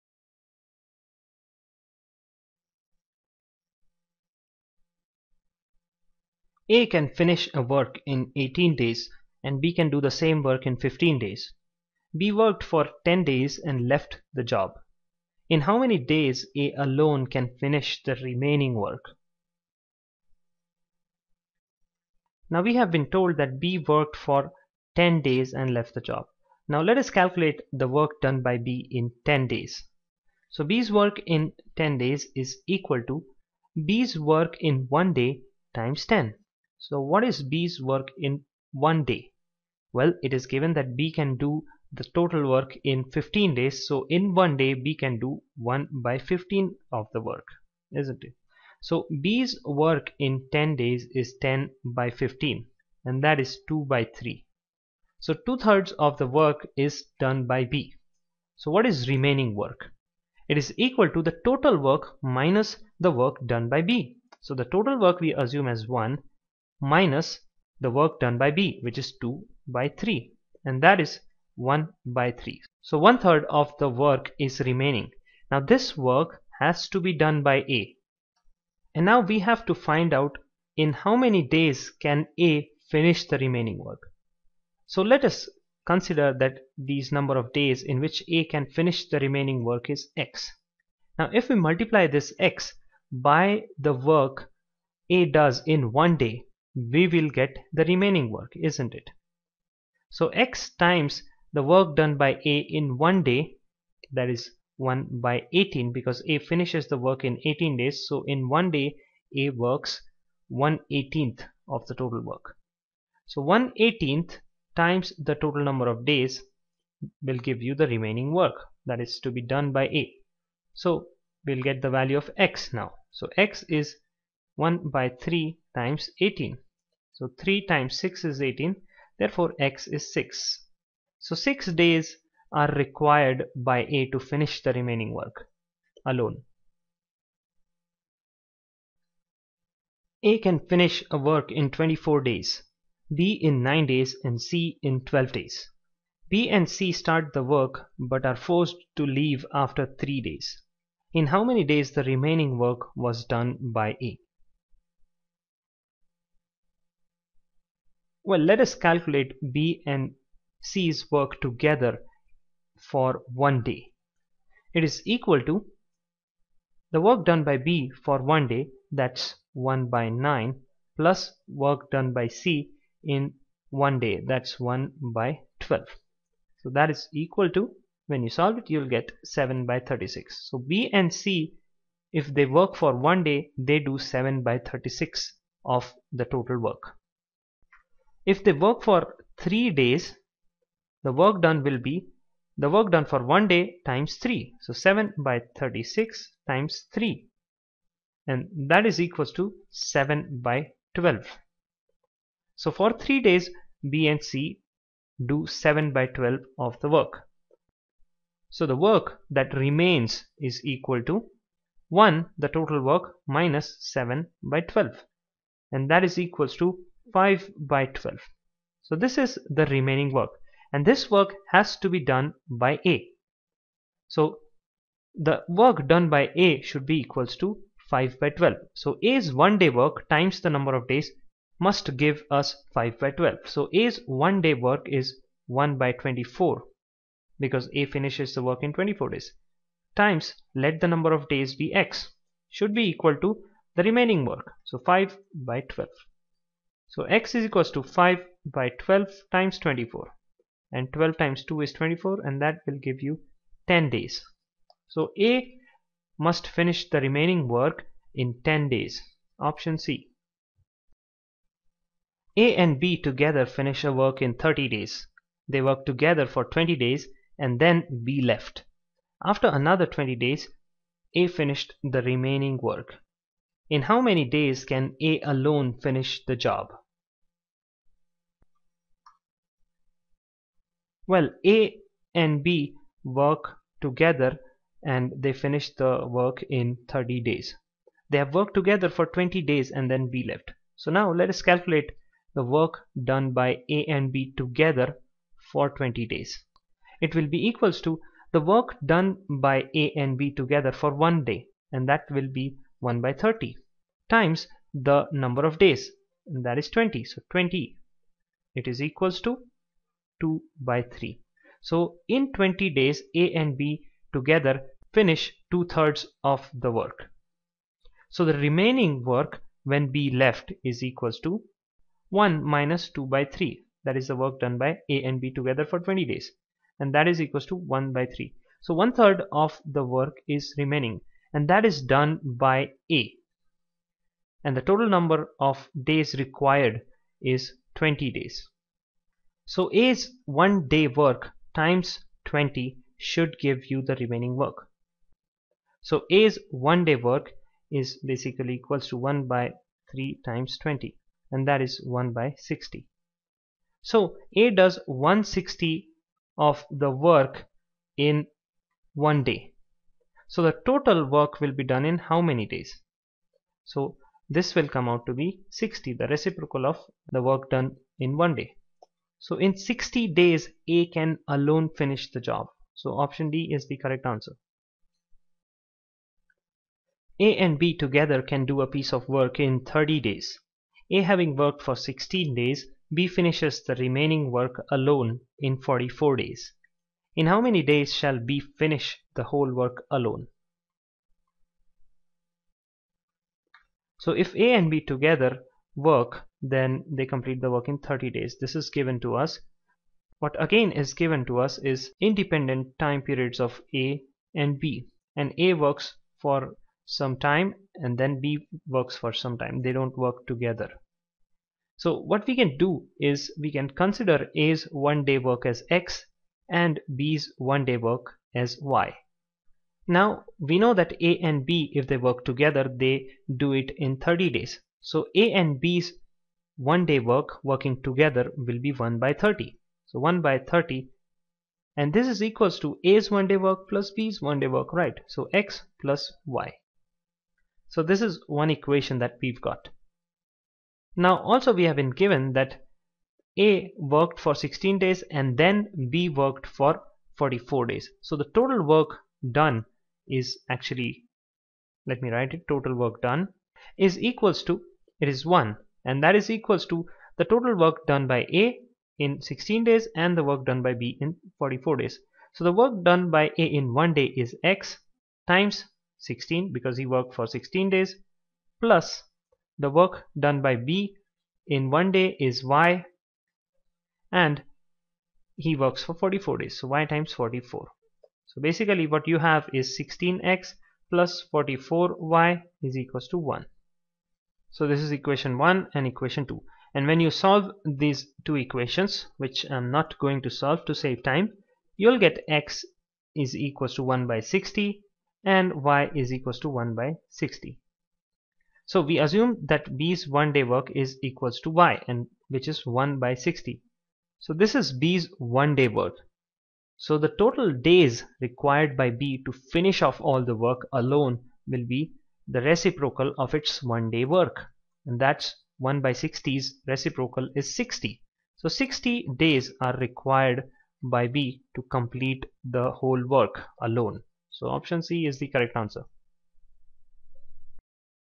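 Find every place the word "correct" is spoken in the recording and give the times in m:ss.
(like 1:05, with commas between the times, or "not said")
6:13, 8:45.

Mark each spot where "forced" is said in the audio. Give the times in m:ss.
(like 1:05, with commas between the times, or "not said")
2:28.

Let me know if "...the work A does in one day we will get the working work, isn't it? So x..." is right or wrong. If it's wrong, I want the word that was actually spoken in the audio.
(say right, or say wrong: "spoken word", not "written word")
wrong: "remaining", not "working".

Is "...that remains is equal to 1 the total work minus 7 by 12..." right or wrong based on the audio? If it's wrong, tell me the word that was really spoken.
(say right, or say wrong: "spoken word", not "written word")
right.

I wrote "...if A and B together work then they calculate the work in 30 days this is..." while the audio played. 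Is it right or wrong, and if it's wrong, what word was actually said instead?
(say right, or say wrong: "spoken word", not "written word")
wrong: "complete", not "calculate".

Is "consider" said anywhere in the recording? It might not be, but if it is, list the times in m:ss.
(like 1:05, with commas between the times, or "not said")
1:25, 6:53.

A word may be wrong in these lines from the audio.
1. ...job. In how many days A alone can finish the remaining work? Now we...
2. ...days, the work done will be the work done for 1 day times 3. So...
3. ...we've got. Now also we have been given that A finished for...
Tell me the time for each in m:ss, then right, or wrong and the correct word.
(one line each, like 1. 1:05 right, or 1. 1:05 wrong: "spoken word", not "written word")
1. 0:14 right
2. 3:09 right
3. 7:19 wrong: "worked", not "finished".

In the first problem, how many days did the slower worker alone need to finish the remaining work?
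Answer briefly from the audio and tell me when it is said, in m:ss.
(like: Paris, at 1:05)
6, at 2:09.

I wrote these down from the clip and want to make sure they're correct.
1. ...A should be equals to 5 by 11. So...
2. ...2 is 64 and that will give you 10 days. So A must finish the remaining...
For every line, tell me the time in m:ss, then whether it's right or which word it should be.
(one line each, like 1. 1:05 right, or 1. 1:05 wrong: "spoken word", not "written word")
1. 3:46 wrong: "12", not "11"
2. 4:11 wrong: "24", not "64".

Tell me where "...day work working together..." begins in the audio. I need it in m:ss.
7:06.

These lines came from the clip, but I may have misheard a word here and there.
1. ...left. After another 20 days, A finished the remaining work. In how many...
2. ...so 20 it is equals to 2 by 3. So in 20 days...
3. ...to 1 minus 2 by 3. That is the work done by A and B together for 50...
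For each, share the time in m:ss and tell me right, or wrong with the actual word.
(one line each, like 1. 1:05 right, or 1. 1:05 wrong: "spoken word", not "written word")
1. 4:28 right
2. 5:07 right
3. 5:21 wrong: "20", not "50".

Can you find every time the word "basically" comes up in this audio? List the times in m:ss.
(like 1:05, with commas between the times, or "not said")
5:48, 7:58.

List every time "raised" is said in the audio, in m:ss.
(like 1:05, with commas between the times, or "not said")
not said.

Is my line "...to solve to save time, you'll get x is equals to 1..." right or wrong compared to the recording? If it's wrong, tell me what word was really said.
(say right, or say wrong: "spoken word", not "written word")
right.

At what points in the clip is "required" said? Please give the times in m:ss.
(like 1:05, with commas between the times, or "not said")
2:12, 5:36, 8:28, 8:39.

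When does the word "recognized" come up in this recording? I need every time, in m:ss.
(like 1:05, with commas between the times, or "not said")
not said.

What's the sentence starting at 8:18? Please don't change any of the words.
So we assume that B's one day work is equals to y and which is 1 by 60.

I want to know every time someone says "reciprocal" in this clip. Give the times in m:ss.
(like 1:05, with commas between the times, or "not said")
6:06, 8:32, 8:36.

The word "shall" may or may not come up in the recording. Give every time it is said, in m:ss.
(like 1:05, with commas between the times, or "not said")
6:27.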